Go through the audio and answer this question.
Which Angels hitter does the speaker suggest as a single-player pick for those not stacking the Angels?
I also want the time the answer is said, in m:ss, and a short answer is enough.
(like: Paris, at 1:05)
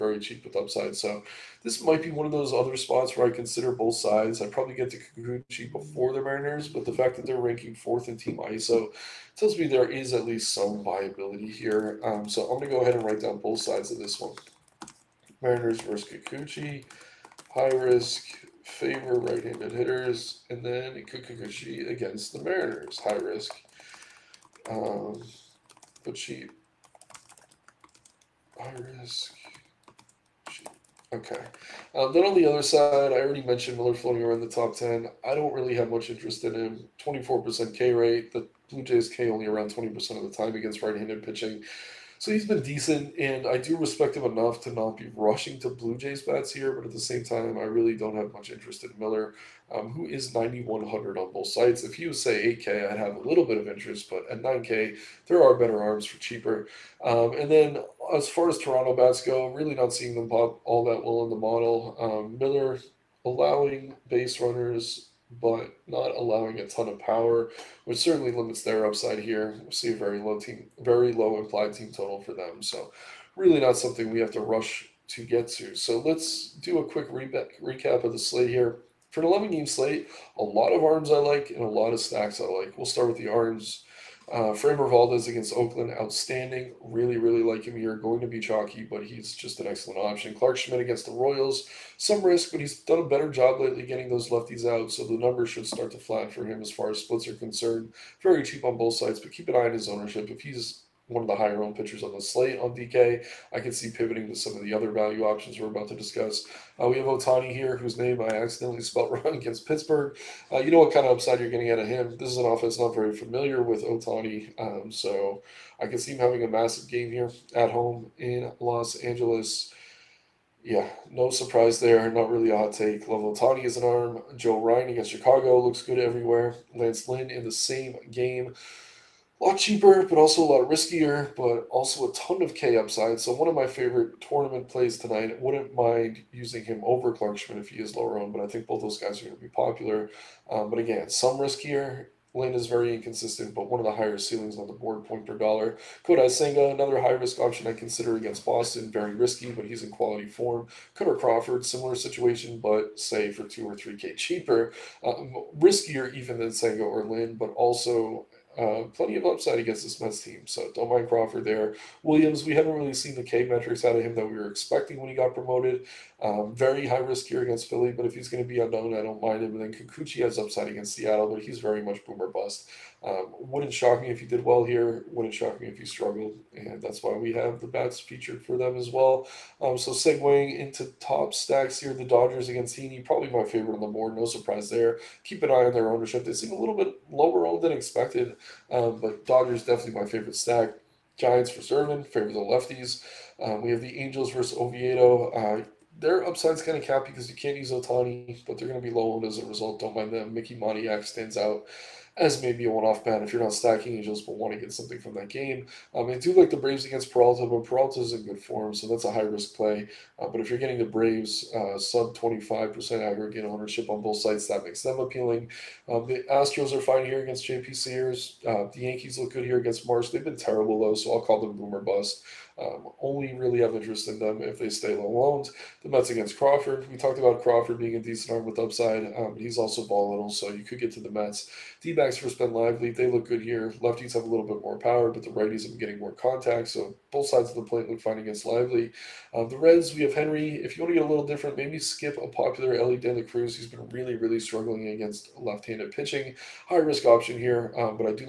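Mickey Moniak, at 3:20.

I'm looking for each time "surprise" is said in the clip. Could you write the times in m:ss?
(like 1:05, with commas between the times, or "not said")
2:01, 3:04.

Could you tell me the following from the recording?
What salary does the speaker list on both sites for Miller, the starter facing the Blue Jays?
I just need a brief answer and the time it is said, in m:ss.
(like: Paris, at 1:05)
9,100, at 0:50.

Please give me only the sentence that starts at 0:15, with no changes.
Mariners versus Kikuchi high risk favor right-handed hitters, and then Kikuchi against the Mariners, high risk.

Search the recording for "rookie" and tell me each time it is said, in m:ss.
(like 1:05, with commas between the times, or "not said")
not said.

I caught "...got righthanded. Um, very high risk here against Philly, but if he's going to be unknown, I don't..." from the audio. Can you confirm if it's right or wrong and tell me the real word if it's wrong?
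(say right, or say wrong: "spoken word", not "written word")
wrong: "promoted", not "righthanded".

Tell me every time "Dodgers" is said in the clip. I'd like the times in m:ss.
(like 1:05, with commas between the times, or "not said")
3:02, 3:09.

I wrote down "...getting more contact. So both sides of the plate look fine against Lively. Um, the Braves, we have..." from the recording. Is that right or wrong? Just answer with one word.
wrong.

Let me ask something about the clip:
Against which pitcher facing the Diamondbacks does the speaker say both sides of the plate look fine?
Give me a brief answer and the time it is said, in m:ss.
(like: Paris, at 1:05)
Ben Lively, at 3:52.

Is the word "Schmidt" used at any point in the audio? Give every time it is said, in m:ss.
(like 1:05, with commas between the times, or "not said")
1:30, 2:17.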